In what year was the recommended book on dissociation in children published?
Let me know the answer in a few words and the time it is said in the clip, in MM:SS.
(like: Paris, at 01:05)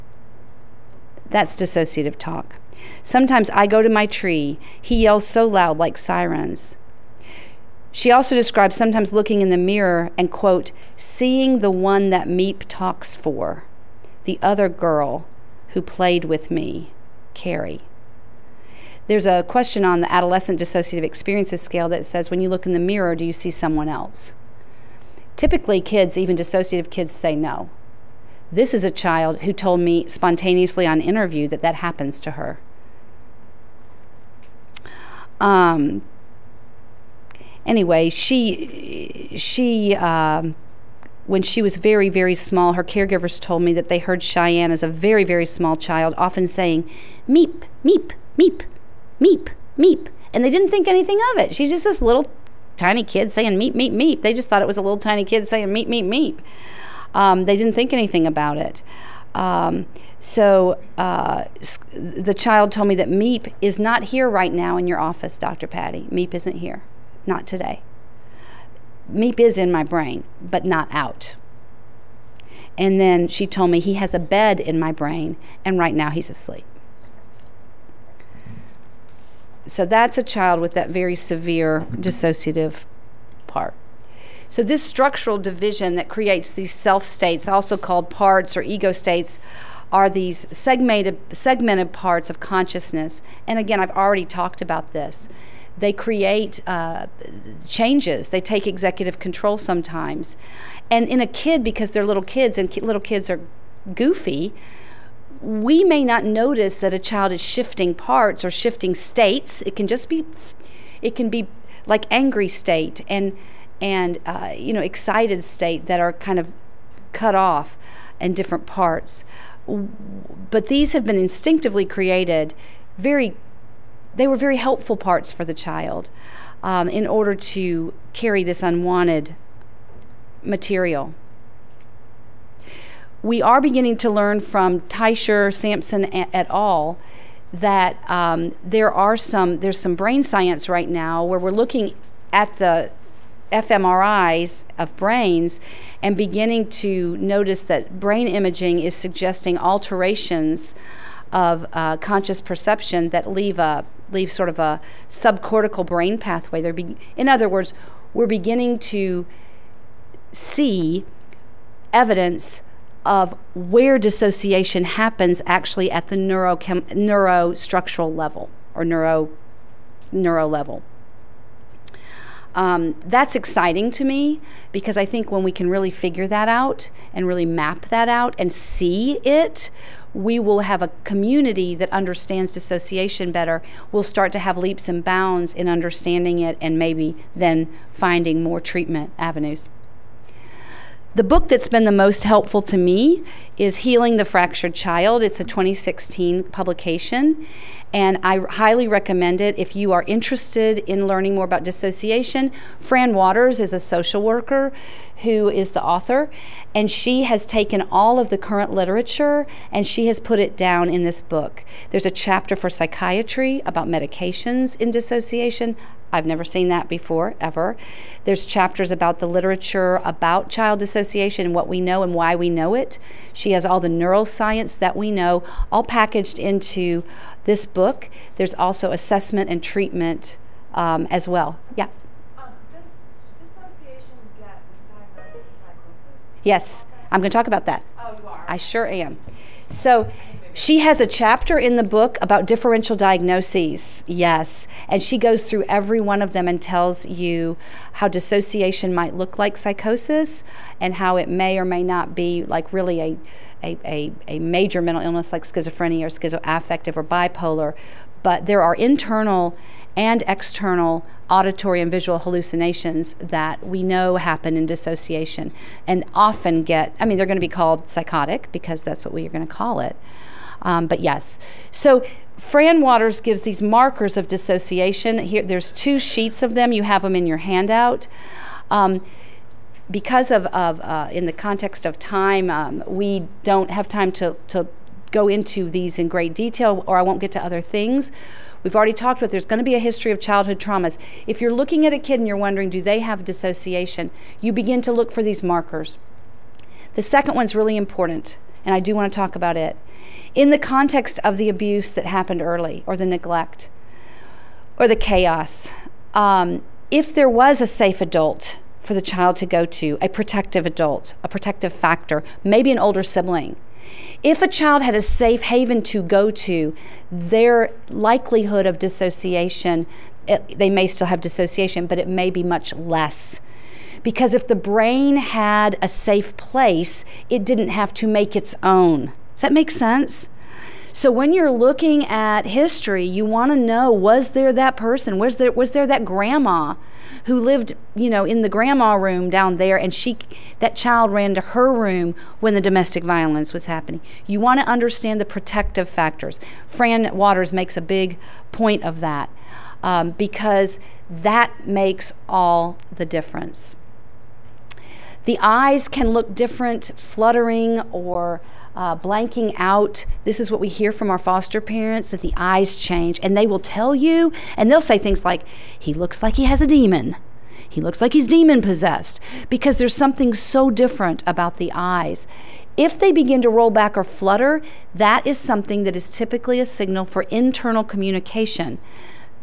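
2016, at 03:15.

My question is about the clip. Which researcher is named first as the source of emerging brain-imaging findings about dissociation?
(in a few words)
Teicher.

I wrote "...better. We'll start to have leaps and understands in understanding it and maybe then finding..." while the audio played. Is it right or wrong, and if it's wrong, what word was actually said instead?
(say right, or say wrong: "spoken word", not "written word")
wrong: "bounds", not "understands".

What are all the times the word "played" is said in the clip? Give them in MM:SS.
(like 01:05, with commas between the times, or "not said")
00:15.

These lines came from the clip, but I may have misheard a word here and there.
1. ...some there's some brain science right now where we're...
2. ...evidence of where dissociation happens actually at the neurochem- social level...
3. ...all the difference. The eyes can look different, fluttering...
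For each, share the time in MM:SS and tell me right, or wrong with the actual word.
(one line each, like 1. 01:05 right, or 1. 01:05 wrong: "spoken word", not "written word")
1. 02:19 right
2. 02:41 wrong: "neurostructural", not "social"
3. 05:52 right.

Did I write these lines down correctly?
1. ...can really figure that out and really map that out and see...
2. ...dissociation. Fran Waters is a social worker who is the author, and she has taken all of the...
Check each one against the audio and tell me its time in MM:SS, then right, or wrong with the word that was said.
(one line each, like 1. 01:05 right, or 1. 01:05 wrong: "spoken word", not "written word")
1. 02:55 right
2. 03:21 right.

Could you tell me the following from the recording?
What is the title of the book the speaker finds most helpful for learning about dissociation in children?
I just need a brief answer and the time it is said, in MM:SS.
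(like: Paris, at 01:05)
Healing the Fractured Child, at 03:13.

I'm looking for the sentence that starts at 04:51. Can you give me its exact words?
If you're looking at a kid and you're wondering, do they have dissociation?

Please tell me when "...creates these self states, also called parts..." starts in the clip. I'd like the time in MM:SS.
01:26.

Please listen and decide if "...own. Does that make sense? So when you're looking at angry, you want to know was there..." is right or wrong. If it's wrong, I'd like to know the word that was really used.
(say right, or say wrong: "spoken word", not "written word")
wrong: "history", not "angry".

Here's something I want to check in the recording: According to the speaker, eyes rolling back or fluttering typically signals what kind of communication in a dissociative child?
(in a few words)
Internal communication.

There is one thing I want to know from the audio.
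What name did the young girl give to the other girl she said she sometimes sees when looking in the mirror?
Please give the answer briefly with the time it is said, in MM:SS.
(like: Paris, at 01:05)
Carrie, at 00:17.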